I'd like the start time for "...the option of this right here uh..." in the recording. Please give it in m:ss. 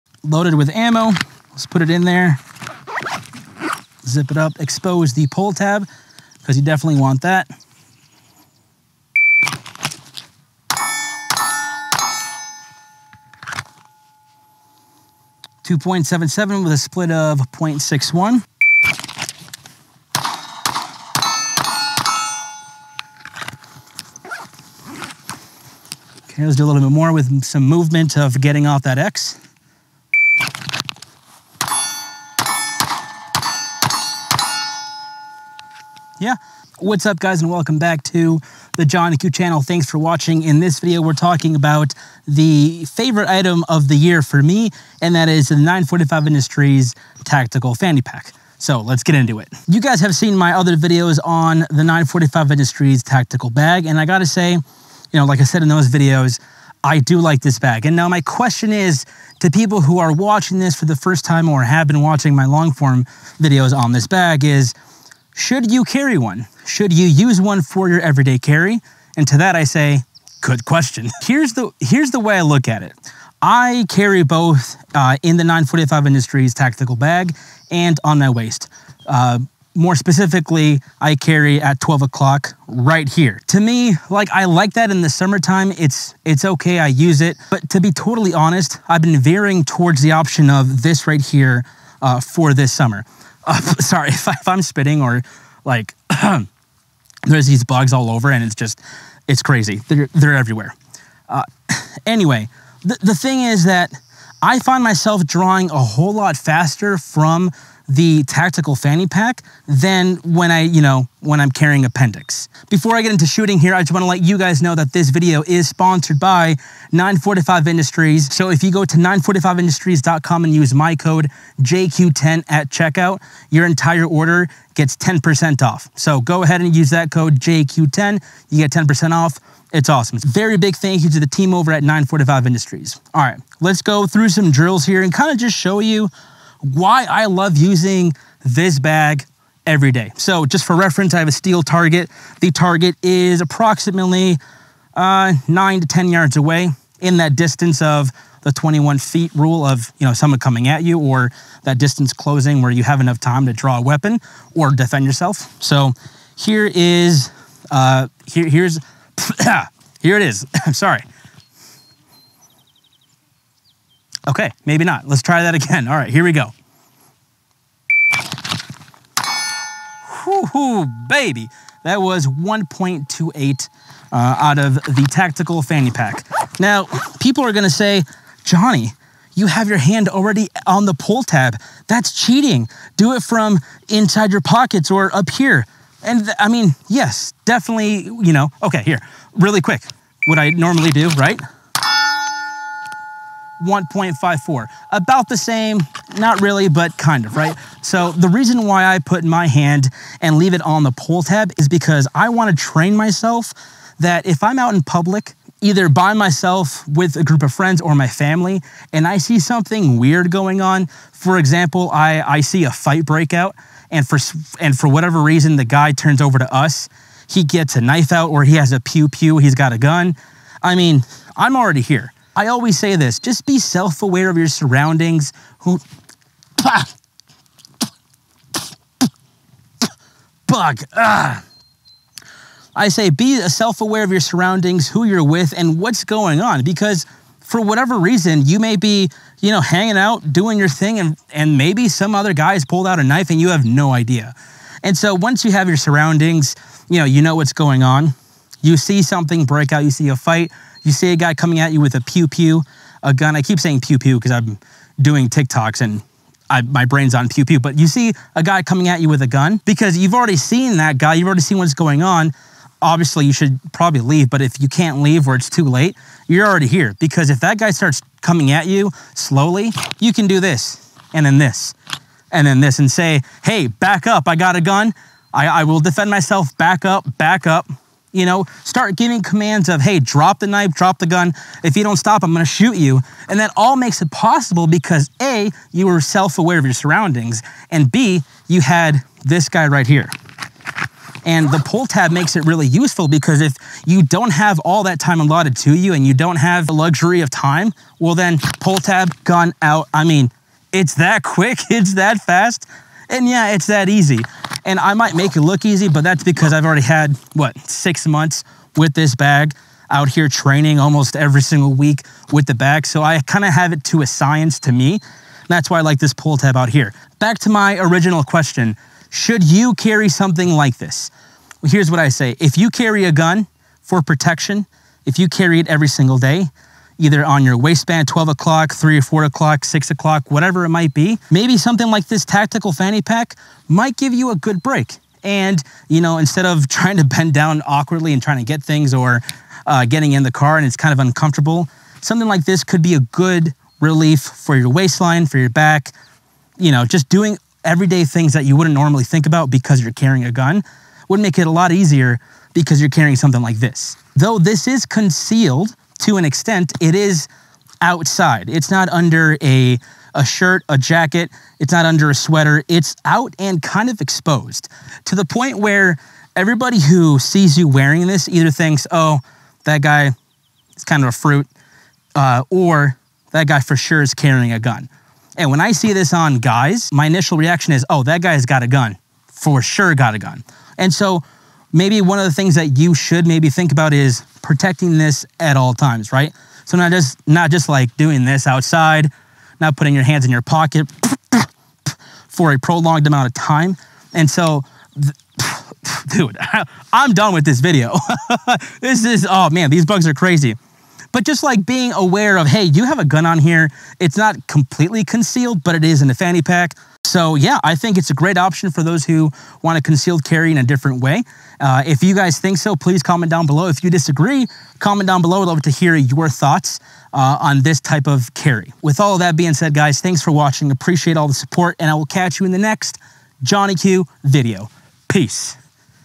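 1:30.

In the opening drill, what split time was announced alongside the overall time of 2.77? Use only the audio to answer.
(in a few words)
0.61.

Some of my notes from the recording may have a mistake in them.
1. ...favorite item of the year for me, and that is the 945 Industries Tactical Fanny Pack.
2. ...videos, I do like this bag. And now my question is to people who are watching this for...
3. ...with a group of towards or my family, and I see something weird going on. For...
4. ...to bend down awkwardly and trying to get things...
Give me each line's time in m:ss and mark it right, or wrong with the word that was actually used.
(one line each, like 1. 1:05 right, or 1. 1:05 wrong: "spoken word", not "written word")
1. 0:42 right
2. 0:55 right
3. 3:26 wrong: "friends", not "towards"
4. 5:36 right.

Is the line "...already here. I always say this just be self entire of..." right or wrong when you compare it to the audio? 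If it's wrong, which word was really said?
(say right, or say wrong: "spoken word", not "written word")
wrong: "aware", not "entire".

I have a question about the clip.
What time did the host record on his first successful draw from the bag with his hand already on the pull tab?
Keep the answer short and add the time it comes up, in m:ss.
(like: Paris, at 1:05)
1.28, at 2:52.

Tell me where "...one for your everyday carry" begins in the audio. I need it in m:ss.
1:07.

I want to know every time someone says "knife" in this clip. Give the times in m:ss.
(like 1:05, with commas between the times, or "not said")
3:37, 4:03, 4:40.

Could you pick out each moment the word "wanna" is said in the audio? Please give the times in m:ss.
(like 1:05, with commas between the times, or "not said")
1:53, 3:22.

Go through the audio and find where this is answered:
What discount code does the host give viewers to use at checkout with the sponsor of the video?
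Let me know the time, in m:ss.
2:01.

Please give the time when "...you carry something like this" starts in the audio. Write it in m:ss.
5:19.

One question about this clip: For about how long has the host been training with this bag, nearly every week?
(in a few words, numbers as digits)
6 months.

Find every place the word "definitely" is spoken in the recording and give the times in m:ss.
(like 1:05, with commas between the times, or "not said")
0:06, 3:07.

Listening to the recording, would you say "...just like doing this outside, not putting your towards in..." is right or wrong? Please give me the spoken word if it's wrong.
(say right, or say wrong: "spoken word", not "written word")
wrong: "hands", not "towards".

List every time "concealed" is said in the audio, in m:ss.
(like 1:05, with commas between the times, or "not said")
5:54, 6:45, 6:49.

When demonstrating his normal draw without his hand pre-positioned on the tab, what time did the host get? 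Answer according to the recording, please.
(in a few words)
1.54.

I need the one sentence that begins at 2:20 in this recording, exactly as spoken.
So just for reference, I have a steel target.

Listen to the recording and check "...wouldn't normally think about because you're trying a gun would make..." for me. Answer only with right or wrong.
wrong.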